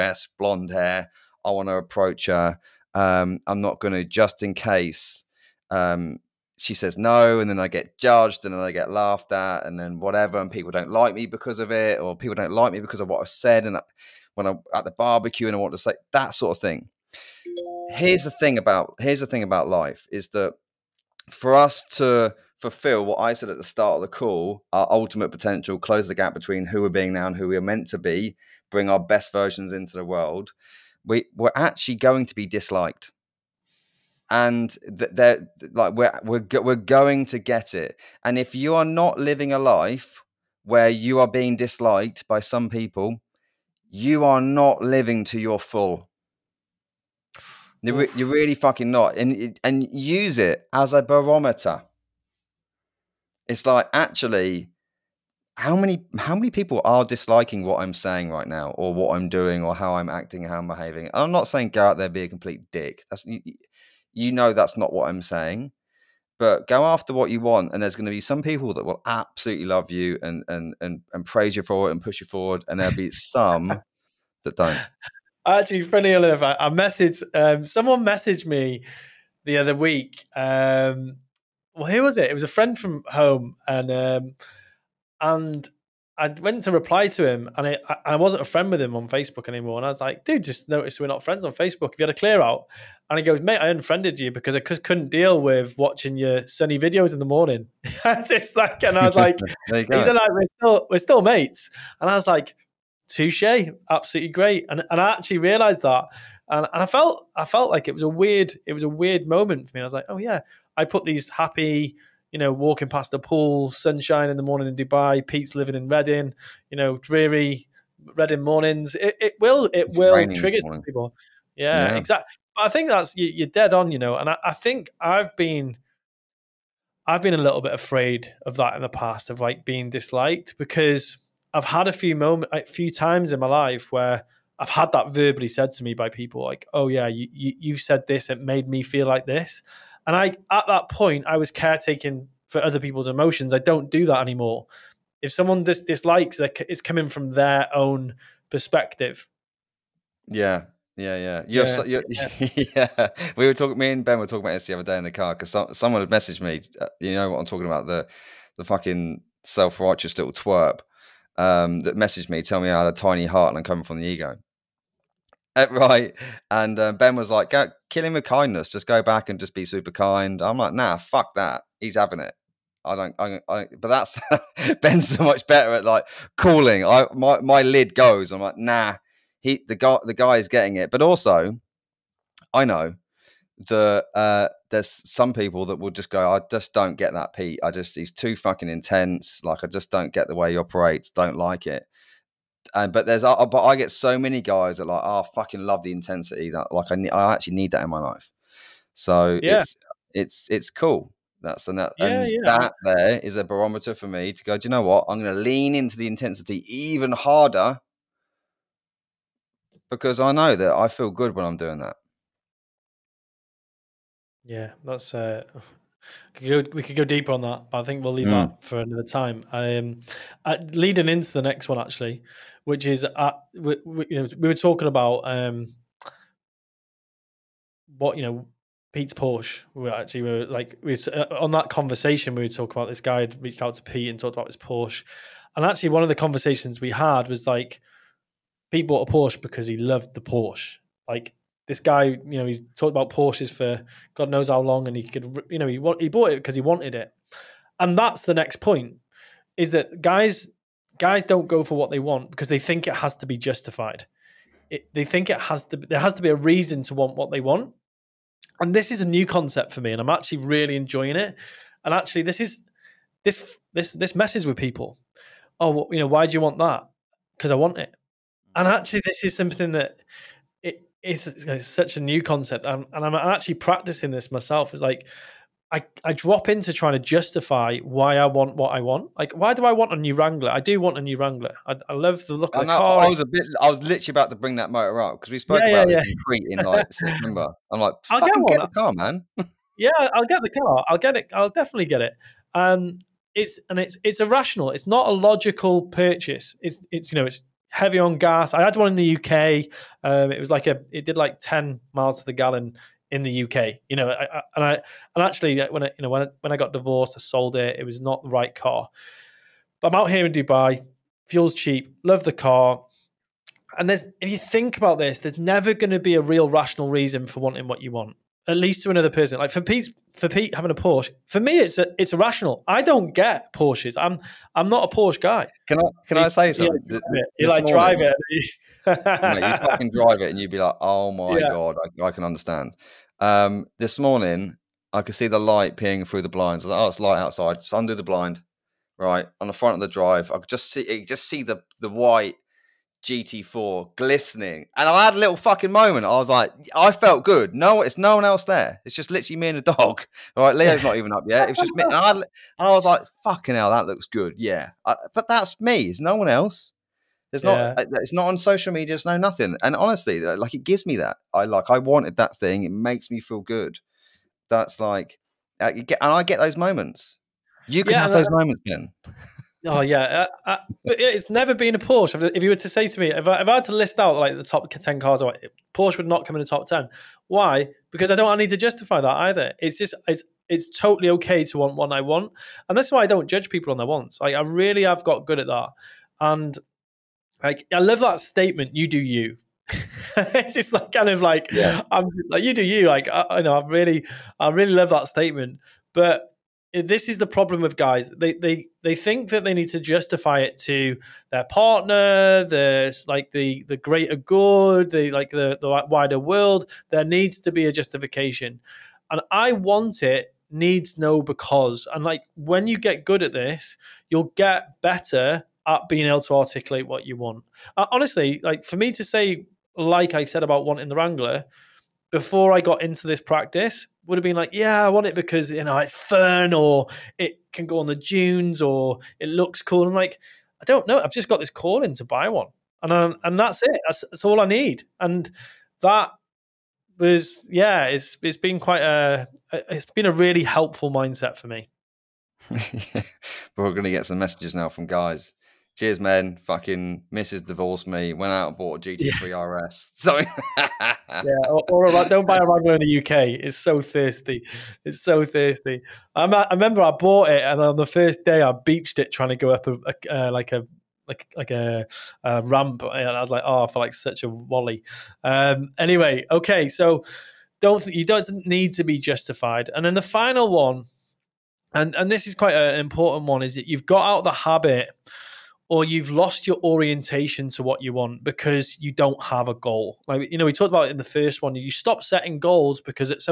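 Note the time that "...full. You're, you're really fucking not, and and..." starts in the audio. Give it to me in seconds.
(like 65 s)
45 s.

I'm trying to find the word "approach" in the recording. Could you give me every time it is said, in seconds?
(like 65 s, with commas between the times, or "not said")
1 s.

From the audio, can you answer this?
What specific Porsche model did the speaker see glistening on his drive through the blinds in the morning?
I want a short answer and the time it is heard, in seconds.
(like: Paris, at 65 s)
GT4, at 343 s.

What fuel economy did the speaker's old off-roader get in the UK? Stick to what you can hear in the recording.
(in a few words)
10 miles to the gallon.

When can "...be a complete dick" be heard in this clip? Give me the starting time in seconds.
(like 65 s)
62 s.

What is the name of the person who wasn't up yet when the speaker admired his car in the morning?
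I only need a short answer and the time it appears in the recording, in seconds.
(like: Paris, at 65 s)
Leo, at 350 s.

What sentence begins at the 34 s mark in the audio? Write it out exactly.
And they're like, we're, we're, we're going to get it.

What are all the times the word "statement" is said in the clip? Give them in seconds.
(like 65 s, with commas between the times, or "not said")
388 s, 395 s.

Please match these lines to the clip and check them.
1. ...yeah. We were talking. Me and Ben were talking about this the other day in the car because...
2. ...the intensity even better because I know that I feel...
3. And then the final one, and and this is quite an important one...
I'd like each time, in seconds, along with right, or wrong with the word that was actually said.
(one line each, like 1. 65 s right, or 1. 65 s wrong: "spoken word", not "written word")
1. 152 s right
2. 205 s wrong: "harder", not "better"
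3. 469 s right.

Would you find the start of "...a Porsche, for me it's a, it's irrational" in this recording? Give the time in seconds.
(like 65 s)
320 s.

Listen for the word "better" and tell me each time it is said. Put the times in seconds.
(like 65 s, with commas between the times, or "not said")
175 s, 414 s.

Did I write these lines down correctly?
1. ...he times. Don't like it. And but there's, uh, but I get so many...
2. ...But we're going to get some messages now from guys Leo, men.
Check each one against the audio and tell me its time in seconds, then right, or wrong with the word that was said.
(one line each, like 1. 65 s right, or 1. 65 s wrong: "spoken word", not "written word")
1. 190 s wrong: "operates", not "times"
2. 443 s wrong: "Cheers", not "Leo".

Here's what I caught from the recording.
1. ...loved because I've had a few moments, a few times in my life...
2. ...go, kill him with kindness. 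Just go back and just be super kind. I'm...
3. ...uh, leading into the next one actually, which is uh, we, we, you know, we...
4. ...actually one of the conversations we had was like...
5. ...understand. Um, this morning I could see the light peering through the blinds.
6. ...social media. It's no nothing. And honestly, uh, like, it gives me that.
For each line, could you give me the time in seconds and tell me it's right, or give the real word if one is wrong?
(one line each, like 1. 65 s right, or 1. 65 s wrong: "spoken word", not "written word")
1. 129 s wrong: "disliked", not "loved"
2. 167 s right
3. 220 s right
4. 235 s right
5. 332 s right
6. 358 s right.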